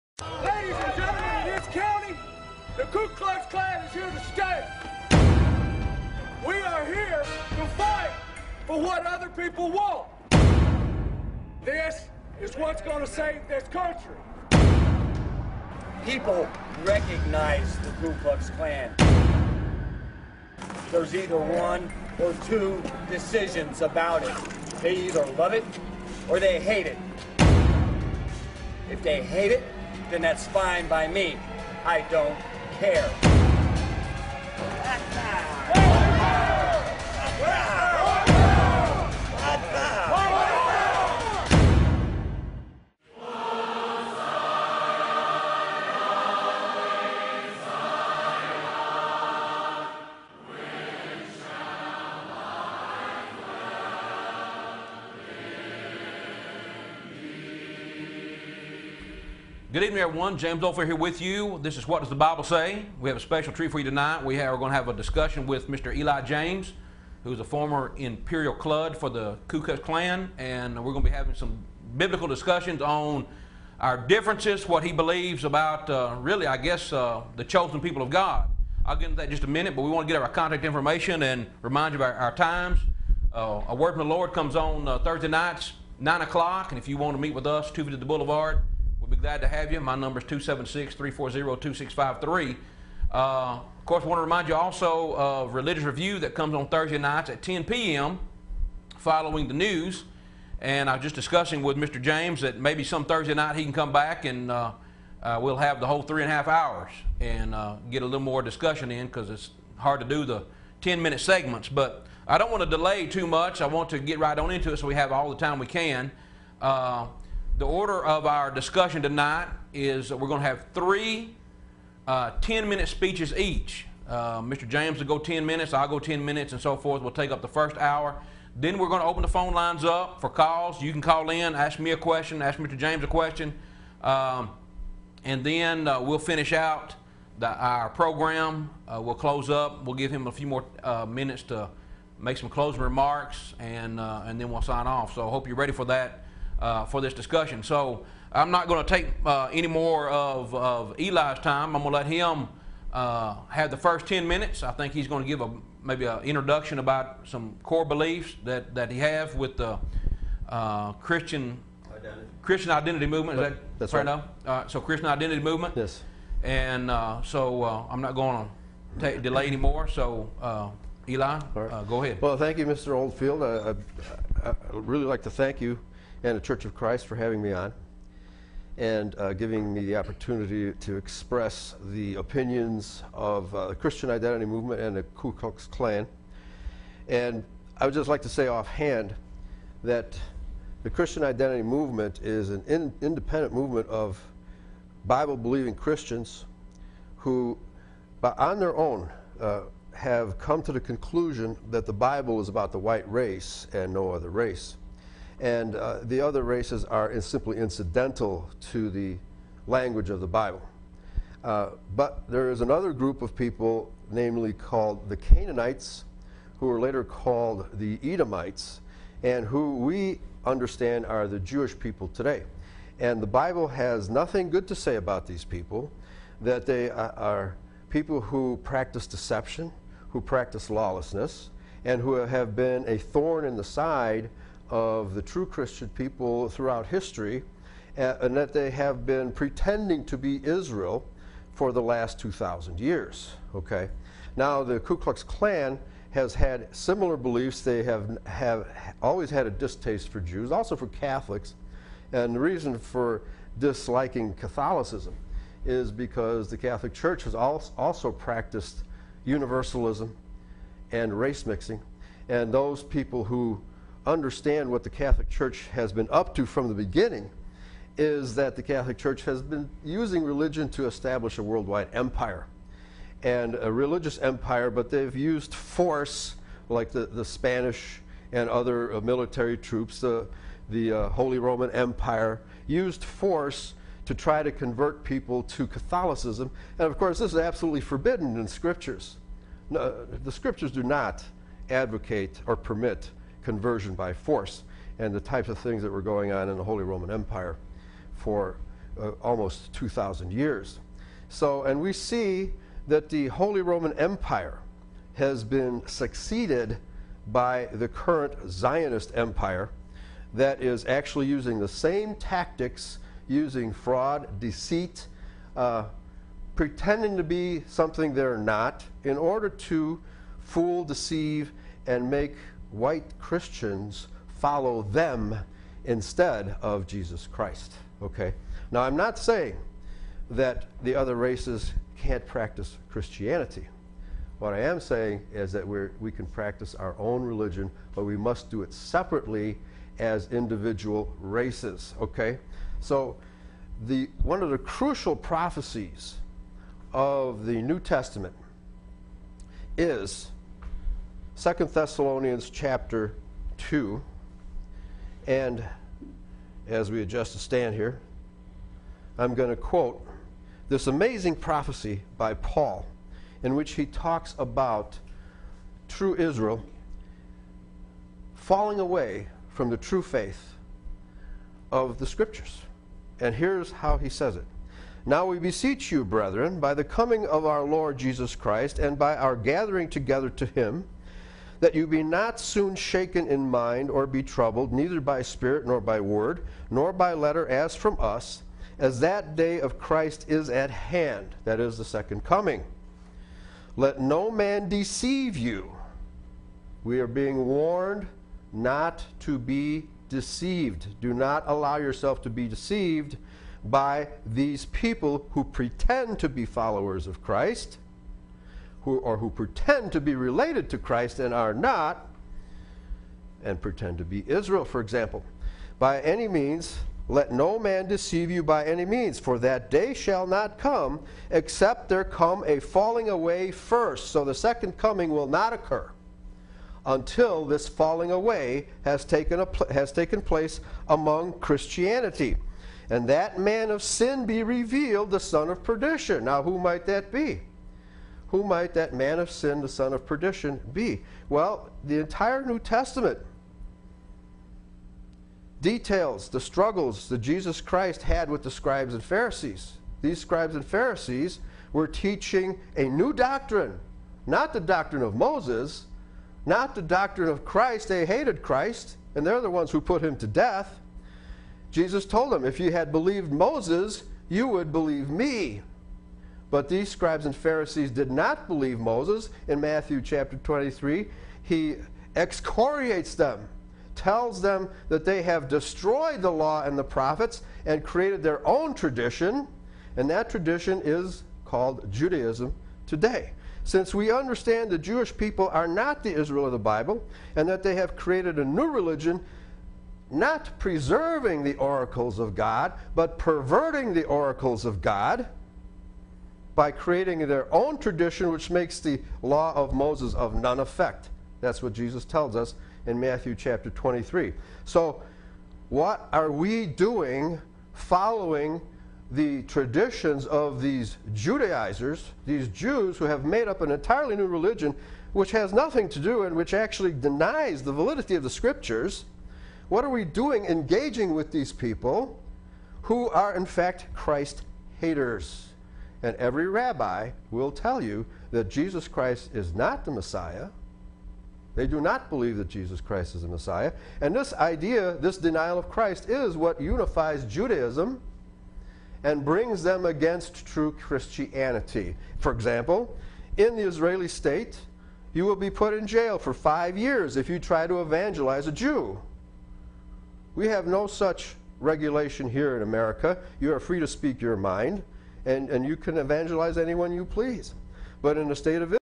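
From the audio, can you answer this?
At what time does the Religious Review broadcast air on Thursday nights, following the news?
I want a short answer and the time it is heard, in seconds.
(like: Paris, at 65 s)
10 p.m., at 97 s.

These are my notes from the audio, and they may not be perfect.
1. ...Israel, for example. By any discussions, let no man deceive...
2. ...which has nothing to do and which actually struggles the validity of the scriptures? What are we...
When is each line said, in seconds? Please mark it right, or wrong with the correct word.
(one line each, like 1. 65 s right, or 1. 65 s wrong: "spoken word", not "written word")
1. 414 s wrong: "means", not "discussions"
2. 515 s wrong: "denies", not "struggles".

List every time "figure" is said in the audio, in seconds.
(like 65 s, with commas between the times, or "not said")
not said.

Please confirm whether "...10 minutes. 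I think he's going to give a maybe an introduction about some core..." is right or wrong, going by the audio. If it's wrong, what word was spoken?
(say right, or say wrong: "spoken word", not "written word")
right.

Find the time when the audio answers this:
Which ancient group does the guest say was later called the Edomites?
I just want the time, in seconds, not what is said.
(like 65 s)
215 s.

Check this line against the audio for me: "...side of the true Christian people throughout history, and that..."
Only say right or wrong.
right.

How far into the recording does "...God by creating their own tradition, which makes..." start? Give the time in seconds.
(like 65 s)
494 s.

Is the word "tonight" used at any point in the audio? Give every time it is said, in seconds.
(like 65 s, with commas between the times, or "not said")
63 s, 119 s.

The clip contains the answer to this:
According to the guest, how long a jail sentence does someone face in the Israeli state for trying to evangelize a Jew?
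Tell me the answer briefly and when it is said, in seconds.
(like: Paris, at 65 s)
5 years, at 546 s.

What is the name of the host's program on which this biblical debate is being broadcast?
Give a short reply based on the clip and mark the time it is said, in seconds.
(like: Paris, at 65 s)
What Does the Bible Say?, at 61 s.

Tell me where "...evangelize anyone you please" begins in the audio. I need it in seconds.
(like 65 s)
555 s.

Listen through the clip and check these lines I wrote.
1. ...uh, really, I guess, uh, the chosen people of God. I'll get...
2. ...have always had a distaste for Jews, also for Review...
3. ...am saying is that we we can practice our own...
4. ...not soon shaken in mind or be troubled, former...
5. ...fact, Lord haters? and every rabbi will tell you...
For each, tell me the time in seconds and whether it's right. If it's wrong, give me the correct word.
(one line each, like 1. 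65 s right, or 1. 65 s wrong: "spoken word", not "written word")
1. 75 s right
2. 248 s wrong: "Catholics", not "Review"
3. 334 s right
4. 382 s wrong: "neither", not "former"
5. 523 s wrong: "Christ", not "Lord".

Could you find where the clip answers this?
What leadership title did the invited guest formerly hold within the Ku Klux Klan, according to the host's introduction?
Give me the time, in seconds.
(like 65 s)
67 s.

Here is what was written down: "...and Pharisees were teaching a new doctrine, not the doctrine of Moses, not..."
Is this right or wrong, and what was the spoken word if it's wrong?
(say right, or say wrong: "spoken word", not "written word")
right.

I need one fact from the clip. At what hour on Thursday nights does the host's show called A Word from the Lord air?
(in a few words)
9 o'clock.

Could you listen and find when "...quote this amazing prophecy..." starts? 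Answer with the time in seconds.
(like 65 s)
359 s.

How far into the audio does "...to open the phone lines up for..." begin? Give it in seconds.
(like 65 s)
129 s.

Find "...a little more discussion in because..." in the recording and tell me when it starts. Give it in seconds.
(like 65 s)
108 s.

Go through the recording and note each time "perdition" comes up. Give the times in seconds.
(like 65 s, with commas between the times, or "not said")
435 s, 440 s.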